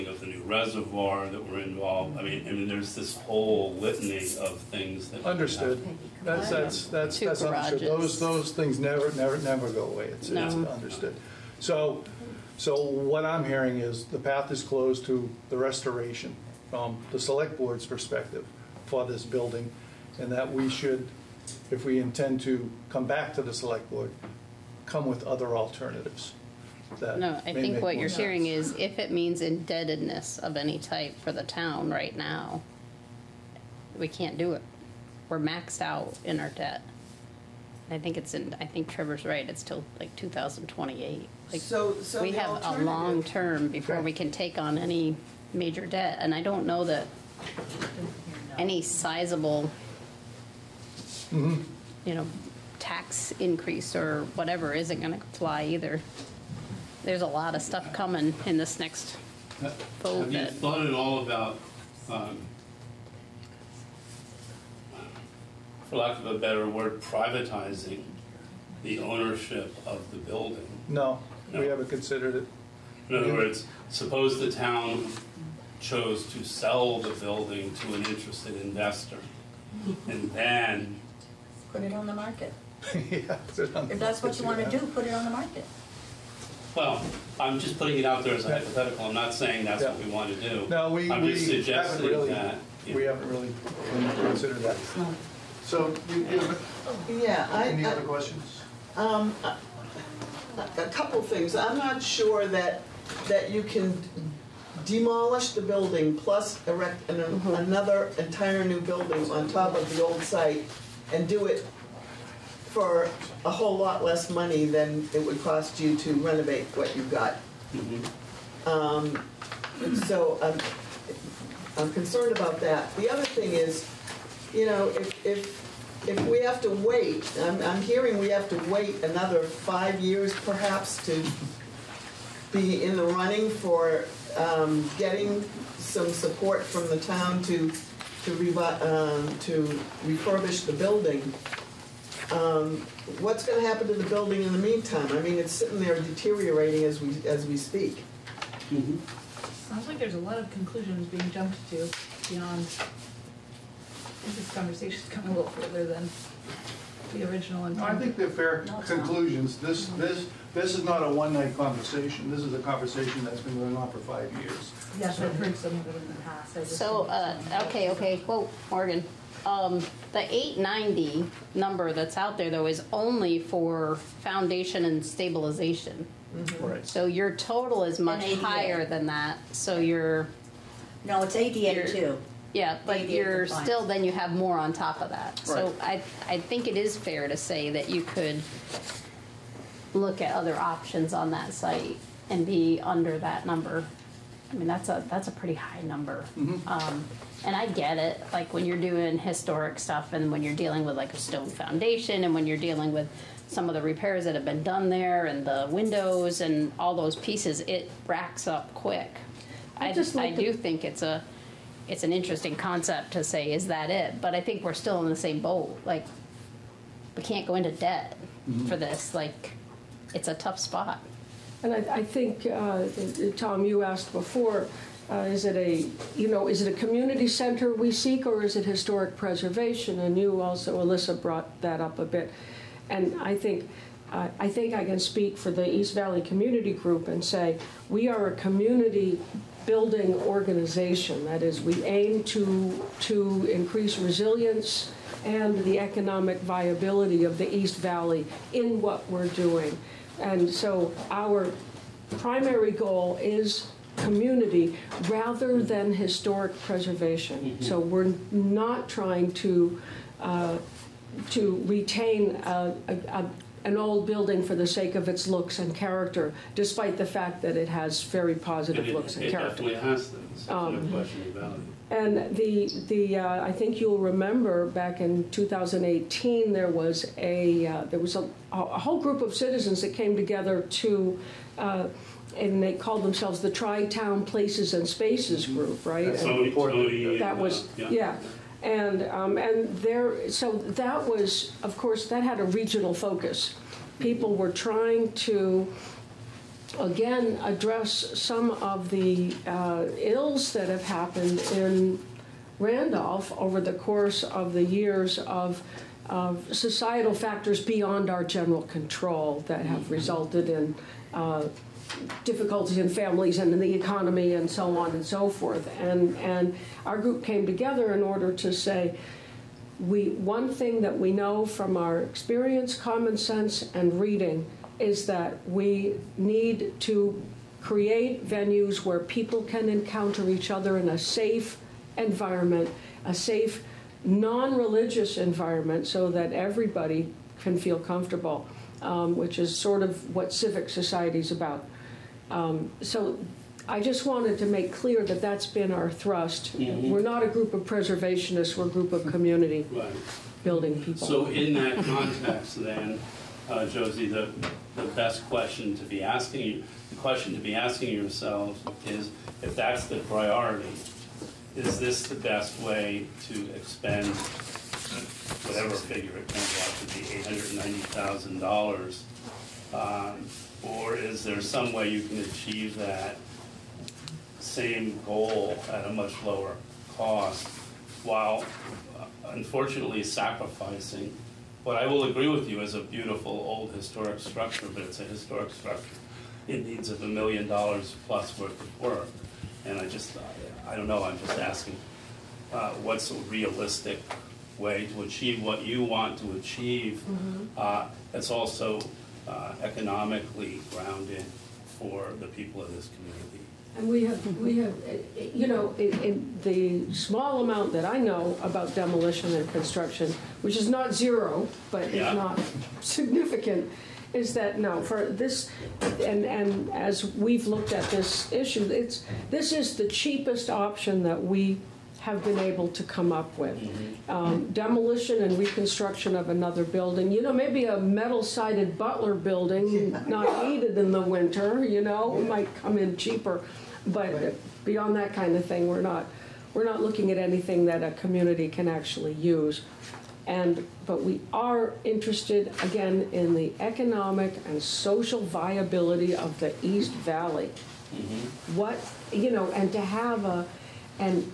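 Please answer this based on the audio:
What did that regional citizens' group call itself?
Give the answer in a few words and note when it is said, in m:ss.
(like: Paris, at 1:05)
Tri-Town Places and Spaces, at 4:43.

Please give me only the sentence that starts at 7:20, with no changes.
And but we are interested again in the economic and social viability of the East Valley.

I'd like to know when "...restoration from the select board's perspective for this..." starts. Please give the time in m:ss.
0:15.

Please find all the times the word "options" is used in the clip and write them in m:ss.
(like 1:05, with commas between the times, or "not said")
3:10, 7:00.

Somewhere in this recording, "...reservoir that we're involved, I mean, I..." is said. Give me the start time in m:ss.
0:00.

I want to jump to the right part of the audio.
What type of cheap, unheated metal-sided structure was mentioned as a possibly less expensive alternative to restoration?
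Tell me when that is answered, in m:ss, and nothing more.
7:08.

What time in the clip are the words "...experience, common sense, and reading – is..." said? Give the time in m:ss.
5:22.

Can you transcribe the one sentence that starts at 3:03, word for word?
still, then you have more on top of that.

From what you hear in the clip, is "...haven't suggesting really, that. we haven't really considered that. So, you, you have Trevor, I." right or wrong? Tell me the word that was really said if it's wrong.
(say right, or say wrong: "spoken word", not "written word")
wrong: "Yeah", not "Trevor".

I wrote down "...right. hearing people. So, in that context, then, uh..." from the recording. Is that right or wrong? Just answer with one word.
wrong.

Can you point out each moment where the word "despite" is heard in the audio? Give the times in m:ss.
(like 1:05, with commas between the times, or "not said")
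4:26.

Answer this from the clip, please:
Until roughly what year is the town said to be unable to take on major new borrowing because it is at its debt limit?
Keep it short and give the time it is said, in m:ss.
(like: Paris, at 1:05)
2028, at 0:40.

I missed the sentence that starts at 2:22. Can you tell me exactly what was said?
Um, what's going to happen to the building in the meantime?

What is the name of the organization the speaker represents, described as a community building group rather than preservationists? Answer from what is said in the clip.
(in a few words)
East Valley Community Group.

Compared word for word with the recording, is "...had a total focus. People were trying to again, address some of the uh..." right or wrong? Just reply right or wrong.
wrong.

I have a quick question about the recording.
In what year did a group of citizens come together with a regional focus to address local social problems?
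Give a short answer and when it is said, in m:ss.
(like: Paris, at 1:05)
2018, at 4:35.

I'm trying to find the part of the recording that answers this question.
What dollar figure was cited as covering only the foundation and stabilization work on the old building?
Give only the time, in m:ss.
2:50.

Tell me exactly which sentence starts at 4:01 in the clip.
That is, we aim to to increase resilience and the economic viability of the East Valley in what we're doing.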